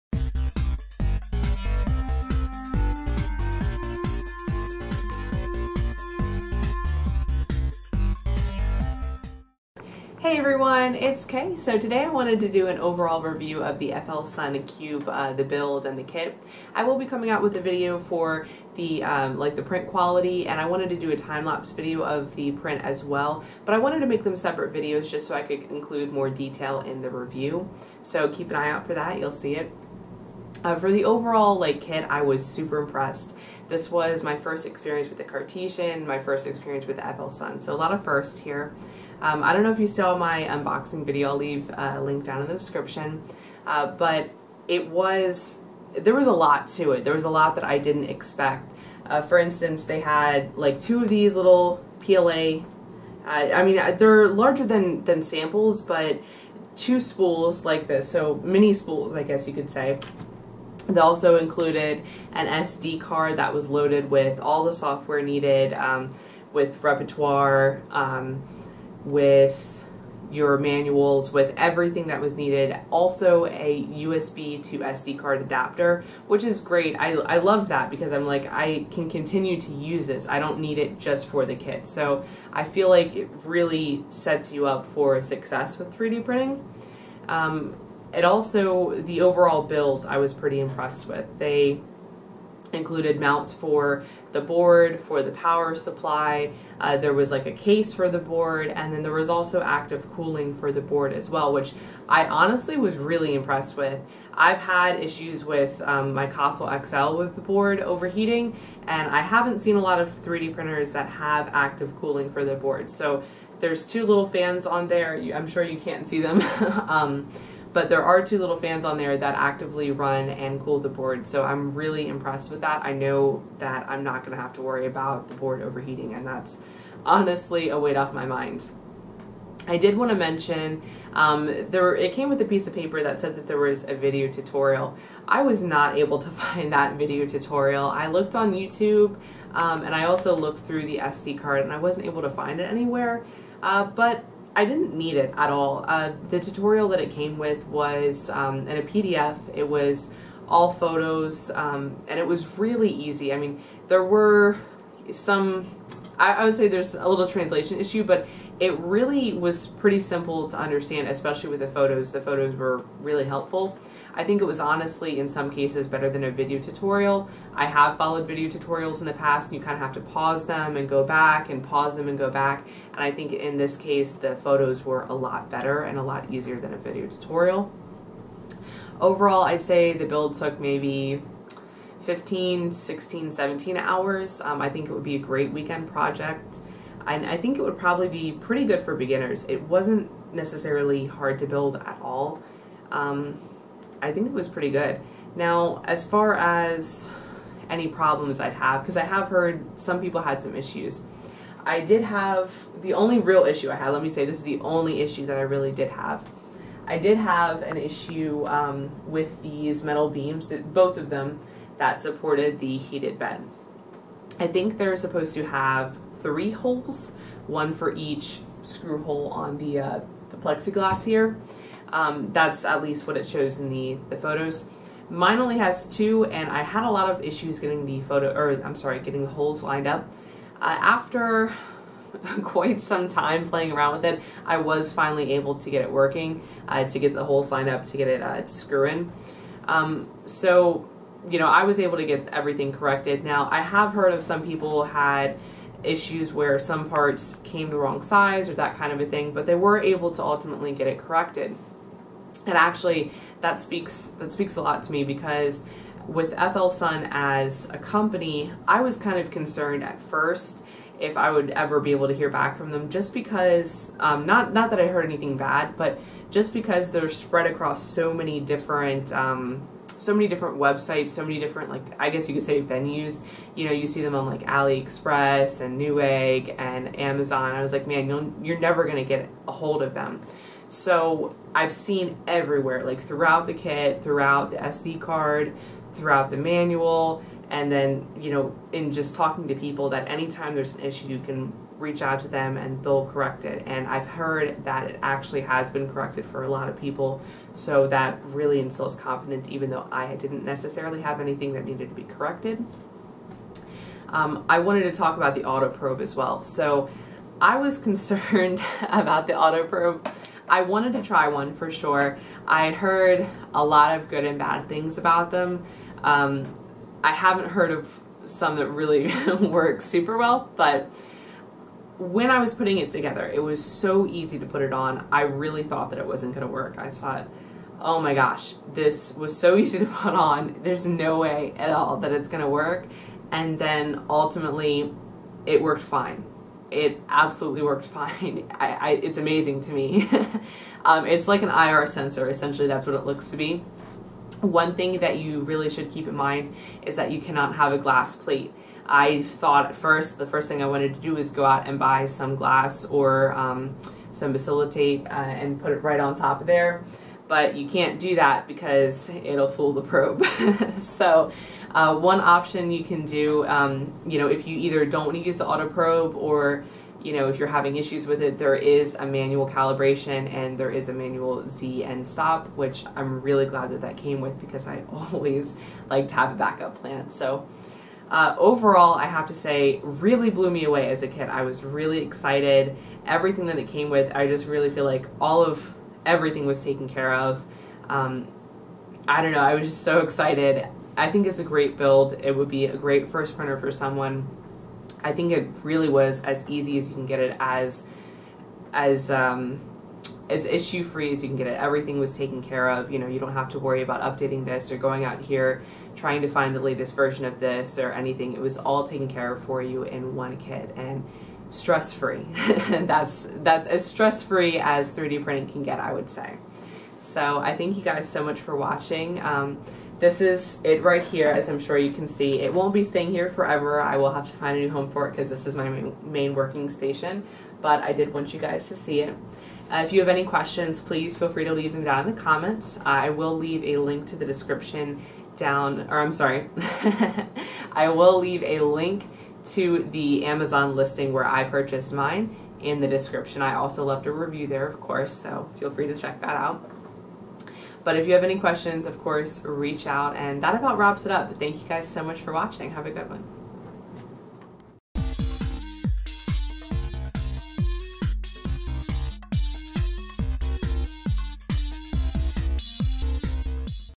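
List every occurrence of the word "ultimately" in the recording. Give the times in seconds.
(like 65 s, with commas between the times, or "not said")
250 s, 334 s.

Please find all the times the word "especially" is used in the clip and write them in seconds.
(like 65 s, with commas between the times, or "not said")
161 s.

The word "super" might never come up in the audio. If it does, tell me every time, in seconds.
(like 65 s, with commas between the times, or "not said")
32 s, 319 s.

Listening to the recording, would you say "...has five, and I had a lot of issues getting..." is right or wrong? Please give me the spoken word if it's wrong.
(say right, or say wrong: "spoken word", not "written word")
wrong: "two", not "five".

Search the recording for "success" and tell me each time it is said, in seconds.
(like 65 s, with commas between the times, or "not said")
85 s.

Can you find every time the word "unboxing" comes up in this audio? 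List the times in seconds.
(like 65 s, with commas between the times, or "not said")
40 s.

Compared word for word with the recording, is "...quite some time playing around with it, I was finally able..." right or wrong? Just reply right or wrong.
right.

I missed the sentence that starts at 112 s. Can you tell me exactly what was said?
So there's two little fans on there.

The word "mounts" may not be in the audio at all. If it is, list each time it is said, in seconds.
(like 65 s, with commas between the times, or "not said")
93 s.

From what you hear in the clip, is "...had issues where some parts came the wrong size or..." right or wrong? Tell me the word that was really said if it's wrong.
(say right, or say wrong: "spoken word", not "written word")
right.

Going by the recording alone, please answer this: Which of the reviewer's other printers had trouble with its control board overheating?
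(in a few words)
Kossel XL.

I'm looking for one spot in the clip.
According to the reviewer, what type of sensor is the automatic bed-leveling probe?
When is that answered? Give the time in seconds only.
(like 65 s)
341 s.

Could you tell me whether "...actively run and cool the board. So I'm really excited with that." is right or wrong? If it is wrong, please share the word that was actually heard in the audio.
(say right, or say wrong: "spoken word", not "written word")
wrong: "impressed", not "excited".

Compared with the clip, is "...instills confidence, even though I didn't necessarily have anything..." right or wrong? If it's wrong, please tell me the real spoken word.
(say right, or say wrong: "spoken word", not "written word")
right.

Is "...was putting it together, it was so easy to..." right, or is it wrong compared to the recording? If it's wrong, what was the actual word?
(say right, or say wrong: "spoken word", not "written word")
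right.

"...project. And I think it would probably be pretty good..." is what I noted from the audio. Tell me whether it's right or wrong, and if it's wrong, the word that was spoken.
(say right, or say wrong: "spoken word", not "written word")
right.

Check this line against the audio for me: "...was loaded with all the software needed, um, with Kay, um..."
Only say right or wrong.
wrong.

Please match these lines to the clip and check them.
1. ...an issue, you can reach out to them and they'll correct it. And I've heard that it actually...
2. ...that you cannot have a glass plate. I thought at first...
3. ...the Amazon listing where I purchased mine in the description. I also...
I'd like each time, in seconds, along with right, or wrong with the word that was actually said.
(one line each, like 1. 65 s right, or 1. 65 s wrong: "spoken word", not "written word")
1. 290 s right
2. 346 s right
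3. 439 s right.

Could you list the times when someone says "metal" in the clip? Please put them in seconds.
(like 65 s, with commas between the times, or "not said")
209 s.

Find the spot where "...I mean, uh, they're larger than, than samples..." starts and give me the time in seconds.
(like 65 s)
53 s.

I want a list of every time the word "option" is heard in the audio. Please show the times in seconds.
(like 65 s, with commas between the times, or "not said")
362 s.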